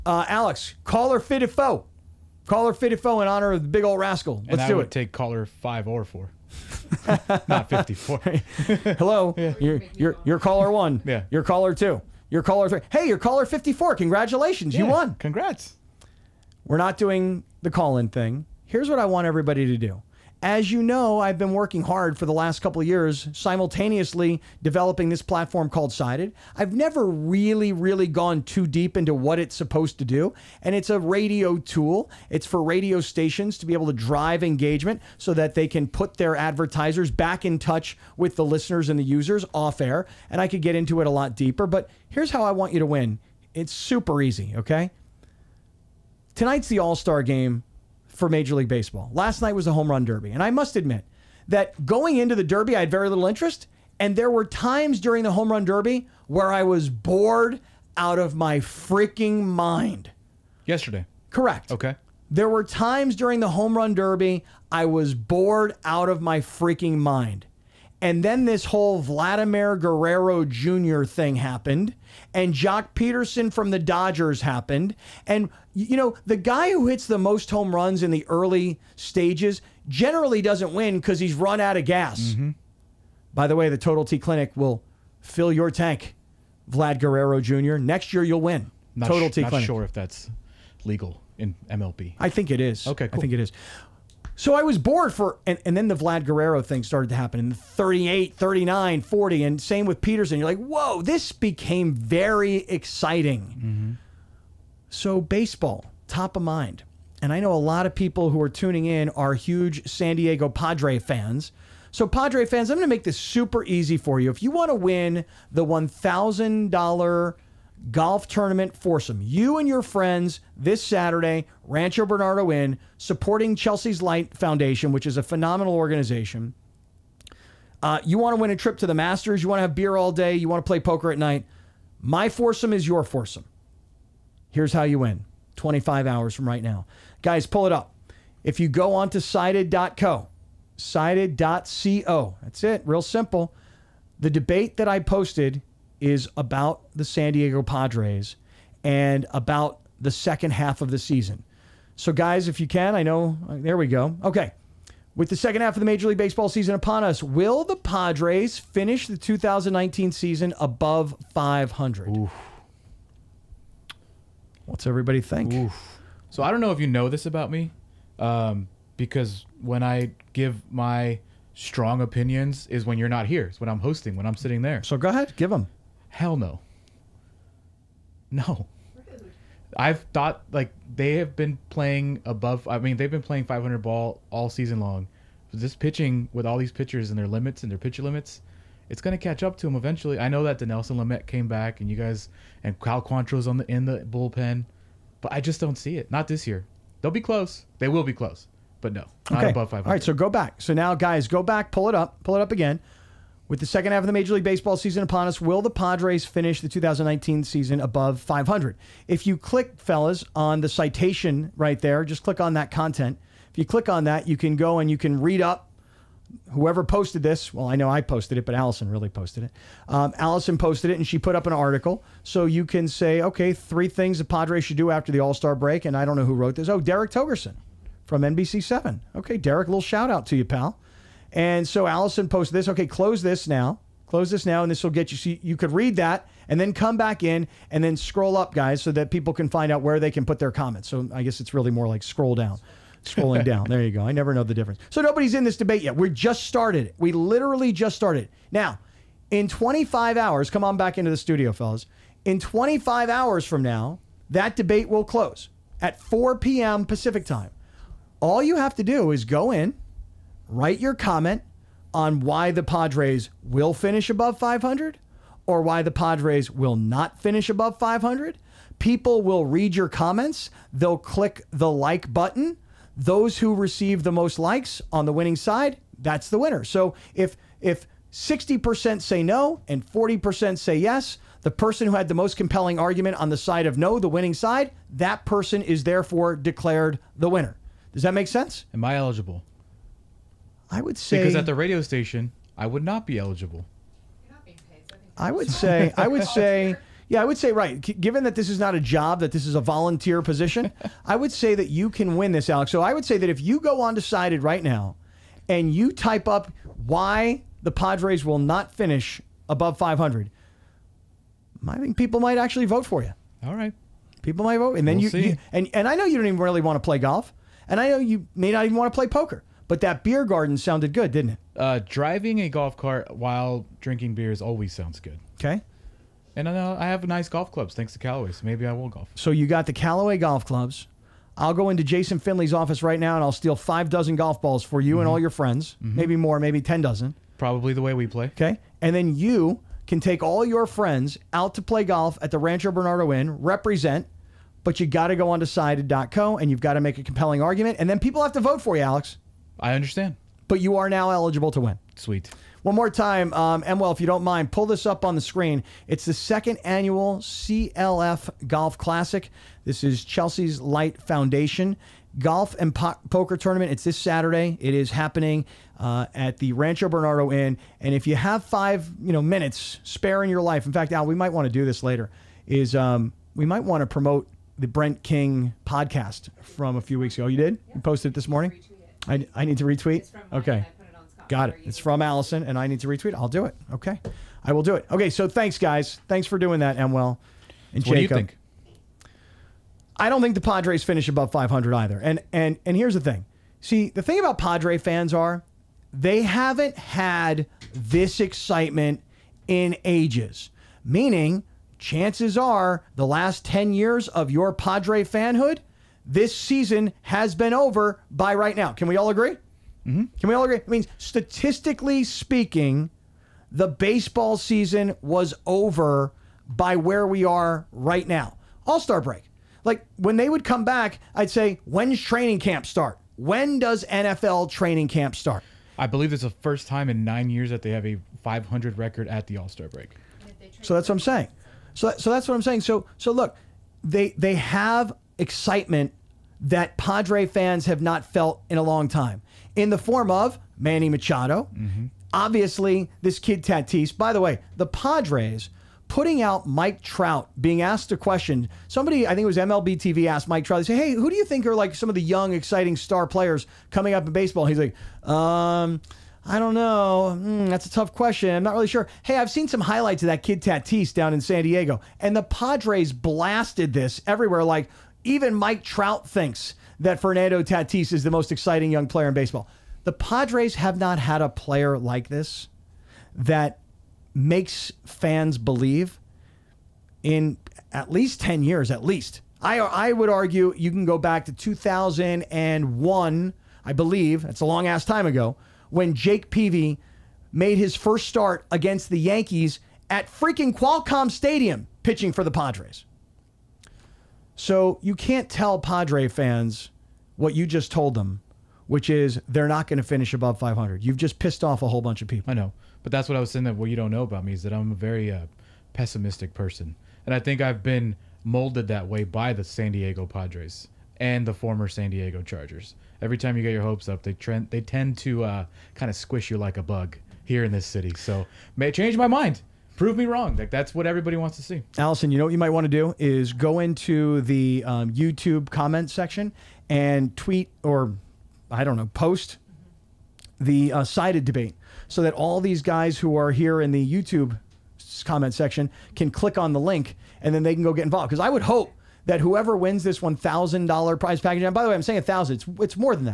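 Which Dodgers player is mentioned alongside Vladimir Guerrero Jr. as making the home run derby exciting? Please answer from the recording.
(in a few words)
Joc Pederson.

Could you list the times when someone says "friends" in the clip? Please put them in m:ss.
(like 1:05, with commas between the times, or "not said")
1:59, 5:35, 5:40.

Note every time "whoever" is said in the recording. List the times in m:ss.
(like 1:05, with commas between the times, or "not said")
3:36, 8:59.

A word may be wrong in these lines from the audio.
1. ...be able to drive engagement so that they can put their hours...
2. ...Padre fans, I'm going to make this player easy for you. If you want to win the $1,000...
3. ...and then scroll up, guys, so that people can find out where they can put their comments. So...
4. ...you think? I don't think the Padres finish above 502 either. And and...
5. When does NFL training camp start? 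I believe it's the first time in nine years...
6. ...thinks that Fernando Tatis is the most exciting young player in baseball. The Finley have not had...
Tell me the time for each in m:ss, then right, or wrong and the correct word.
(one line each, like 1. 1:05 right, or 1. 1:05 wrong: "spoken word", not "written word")
1. 0:33 wrong: "advertisers", not "hours"
2. 1:52 wrong: "super", not "player"
3. 3:57 right
4. 6:28 wrong: "500", not "502"
5. 7:03 right
6. 7:46 wrong: "Padres", not "Finley".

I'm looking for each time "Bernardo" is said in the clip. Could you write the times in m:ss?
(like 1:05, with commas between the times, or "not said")
2:02, 5:42, 6:06.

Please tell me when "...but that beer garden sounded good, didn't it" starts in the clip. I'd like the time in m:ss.
5:19.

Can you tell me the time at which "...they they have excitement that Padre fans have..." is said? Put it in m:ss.
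7:13.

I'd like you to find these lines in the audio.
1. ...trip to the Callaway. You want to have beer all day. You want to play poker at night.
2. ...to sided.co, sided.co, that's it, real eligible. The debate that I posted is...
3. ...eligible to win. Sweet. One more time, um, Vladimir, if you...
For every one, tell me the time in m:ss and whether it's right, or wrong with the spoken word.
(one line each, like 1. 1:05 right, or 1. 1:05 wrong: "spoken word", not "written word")
1. 2:08 wrong: "Masters", not "Callaway"
2. 2:19 wrong: "simple", not "eligible"
3. 5:51 wrong: "Emwell", not "Vladimir".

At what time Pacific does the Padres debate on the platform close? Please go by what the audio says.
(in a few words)
4 p.m.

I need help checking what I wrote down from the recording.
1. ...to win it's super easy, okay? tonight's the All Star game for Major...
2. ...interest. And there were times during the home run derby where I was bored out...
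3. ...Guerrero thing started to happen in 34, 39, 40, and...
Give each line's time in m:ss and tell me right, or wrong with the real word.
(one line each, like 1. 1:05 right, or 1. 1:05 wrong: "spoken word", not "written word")
1. 0:42 right
2. 0:53 right
3. 1:36 wrong: "38", not "34".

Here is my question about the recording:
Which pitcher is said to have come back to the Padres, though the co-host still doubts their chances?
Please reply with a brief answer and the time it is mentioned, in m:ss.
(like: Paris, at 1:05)
Dinelson Lamet, at 3:10.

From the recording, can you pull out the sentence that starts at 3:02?
I mean, they've been playing 500 ball all season long.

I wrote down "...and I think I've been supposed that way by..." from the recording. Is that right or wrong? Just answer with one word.
wrong.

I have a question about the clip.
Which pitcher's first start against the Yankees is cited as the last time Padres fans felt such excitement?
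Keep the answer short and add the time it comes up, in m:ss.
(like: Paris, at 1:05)
Jake Peavy, at 8:05.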